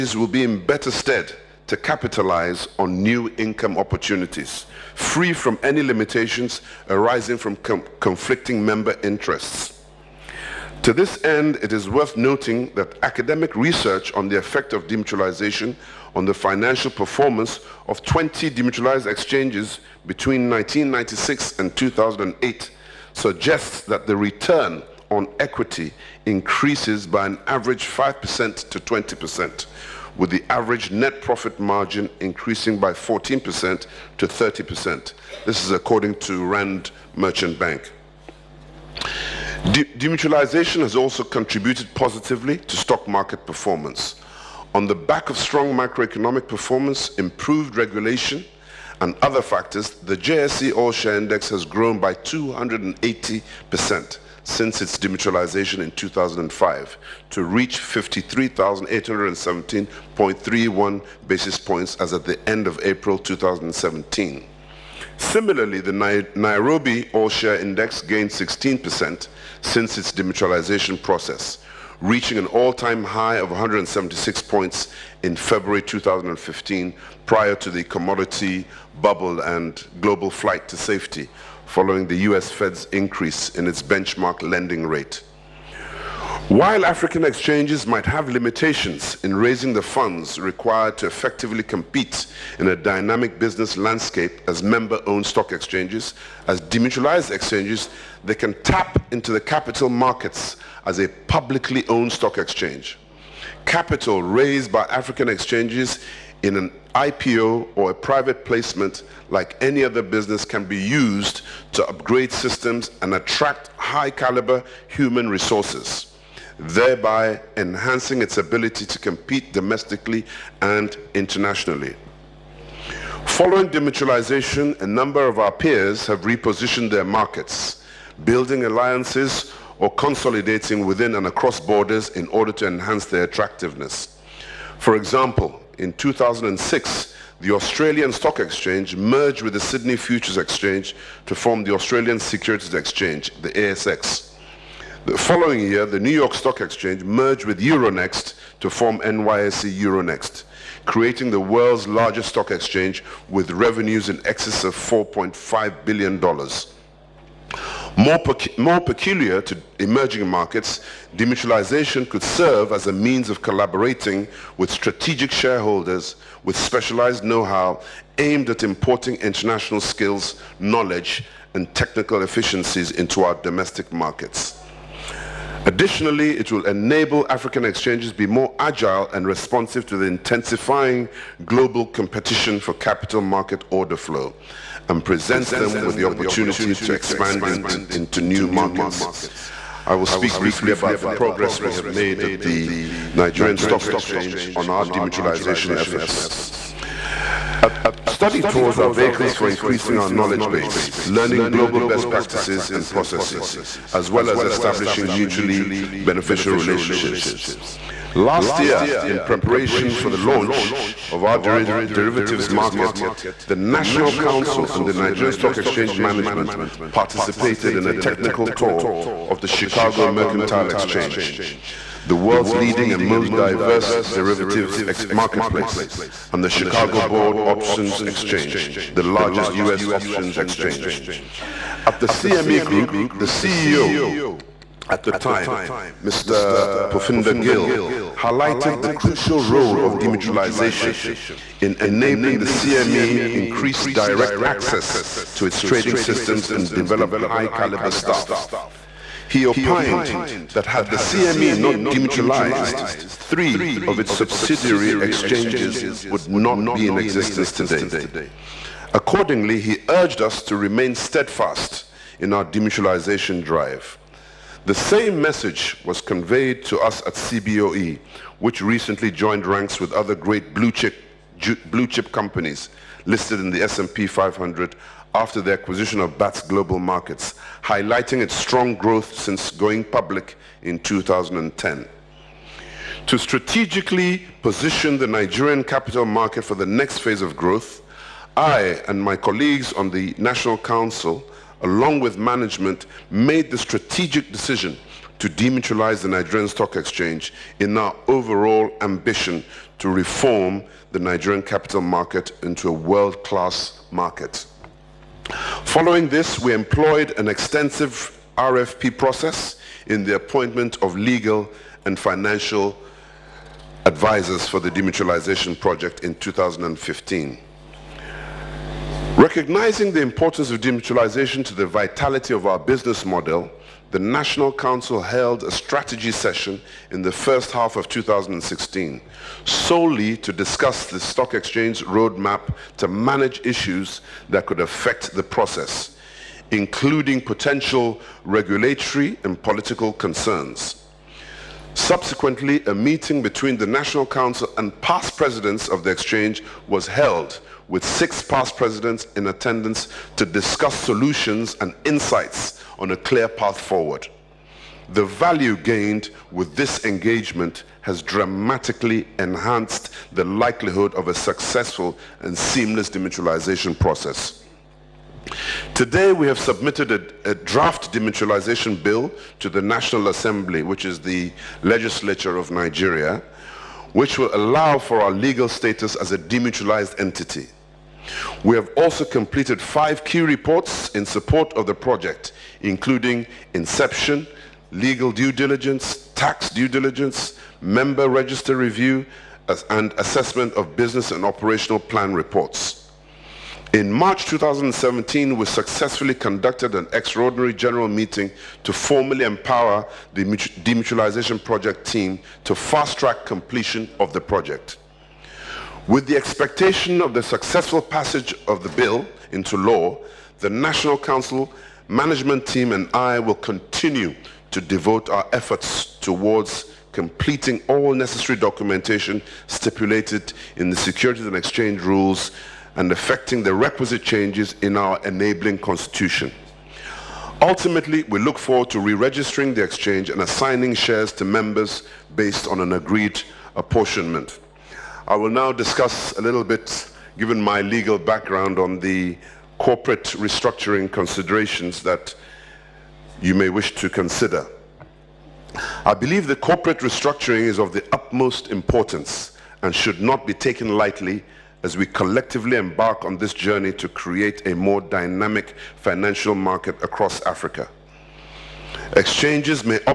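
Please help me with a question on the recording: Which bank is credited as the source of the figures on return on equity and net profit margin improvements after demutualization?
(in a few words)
Rand Merchant Bank.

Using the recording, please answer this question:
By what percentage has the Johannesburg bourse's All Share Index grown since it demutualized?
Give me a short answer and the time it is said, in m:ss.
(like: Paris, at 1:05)
280%, at 0:52.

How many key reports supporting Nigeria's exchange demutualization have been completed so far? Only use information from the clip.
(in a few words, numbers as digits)
5.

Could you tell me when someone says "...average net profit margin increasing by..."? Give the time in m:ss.
0:30.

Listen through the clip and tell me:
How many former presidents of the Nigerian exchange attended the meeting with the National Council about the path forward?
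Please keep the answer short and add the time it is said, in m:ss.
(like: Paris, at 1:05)
6, at 5:47.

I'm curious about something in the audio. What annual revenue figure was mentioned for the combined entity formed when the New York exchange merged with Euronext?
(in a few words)
$4.5 billion.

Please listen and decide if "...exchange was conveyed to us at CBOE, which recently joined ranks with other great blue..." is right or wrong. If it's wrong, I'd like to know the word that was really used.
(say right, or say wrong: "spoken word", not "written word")
wrong: "message", not "exchange".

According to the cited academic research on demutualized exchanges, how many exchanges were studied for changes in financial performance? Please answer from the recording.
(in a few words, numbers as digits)
20.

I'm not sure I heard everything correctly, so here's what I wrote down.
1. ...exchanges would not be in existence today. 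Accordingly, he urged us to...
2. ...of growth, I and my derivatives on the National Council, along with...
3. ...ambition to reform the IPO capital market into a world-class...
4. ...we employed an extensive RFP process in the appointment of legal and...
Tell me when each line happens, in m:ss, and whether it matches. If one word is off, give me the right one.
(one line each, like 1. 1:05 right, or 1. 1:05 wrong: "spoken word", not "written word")
1. 4:15 right
2. 4:47 wrong: "colleagues", not "derivatives"
3. 4:58 wrong: "Nigerian", not "IPO"
4. 5:06 right.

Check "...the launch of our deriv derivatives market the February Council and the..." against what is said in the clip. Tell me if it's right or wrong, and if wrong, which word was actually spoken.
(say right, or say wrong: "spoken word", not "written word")
wrong: "National", not "February".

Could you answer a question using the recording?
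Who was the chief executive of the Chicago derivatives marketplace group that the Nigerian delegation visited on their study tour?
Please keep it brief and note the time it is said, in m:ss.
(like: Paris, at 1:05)
Phupinder Gill, at 3:56.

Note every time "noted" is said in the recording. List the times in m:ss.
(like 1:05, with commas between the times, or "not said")
not said.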